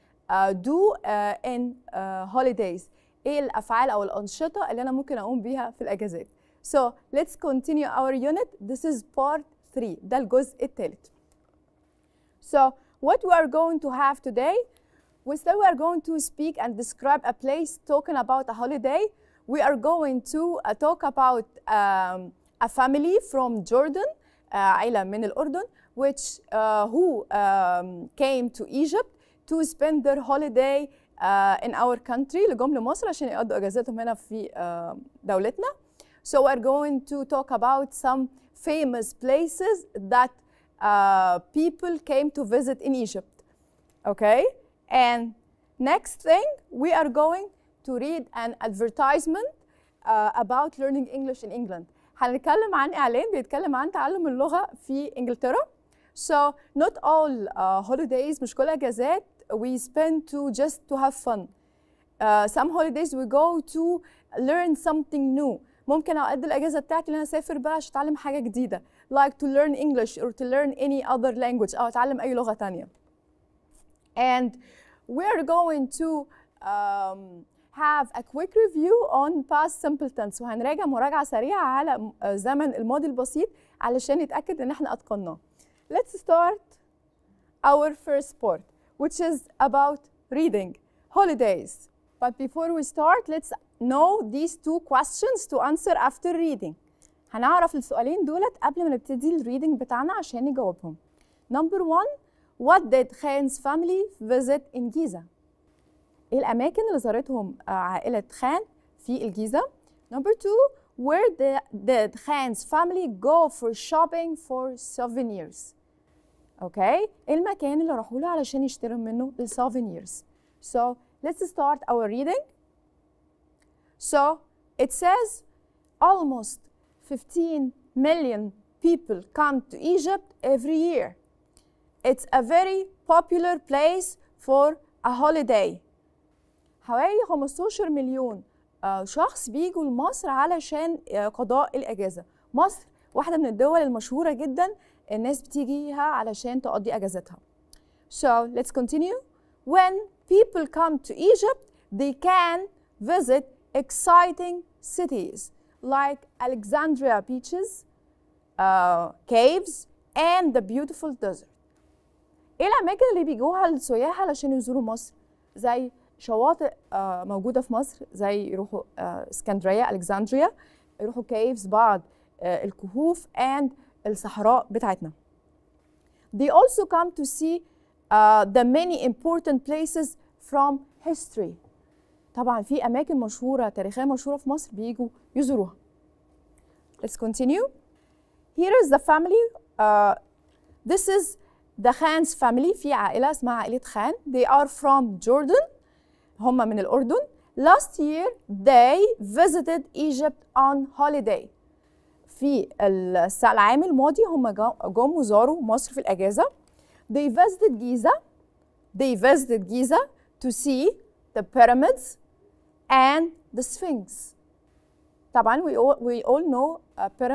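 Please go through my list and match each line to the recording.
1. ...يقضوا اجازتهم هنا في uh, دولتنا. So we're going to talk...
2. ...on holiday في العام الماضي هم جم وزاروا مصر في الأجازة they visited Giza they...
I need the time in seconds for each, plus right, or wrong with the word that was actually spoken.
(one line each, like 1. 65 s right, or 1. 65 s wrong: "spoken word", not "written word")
1. 33 s right
2. 200 s right.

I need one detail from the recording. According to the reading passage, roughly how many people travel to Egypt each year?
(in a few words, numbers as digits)
15 million.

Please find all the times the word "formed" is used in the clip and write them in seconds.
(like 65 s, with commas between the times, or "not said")
not said.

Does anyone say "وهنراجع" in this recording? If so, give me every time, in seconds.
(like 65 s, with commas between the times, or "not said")
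80 s.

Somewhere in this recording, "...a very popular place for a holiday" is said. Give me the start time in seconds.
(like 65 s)
132 s.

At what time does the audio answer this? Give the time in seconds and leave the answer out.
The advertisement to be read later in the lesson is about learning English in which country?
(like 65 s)
51 s.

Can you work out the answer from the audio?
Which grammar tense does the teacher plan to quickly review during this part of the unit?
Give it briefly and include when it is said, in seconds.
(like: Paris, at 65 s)
Past simple, at 79 s.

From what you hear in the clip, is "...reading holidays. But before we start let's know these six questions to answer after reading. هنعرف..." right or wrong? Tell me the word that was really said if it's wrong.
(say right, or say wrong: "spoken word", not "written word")
wrong: "two", not "six".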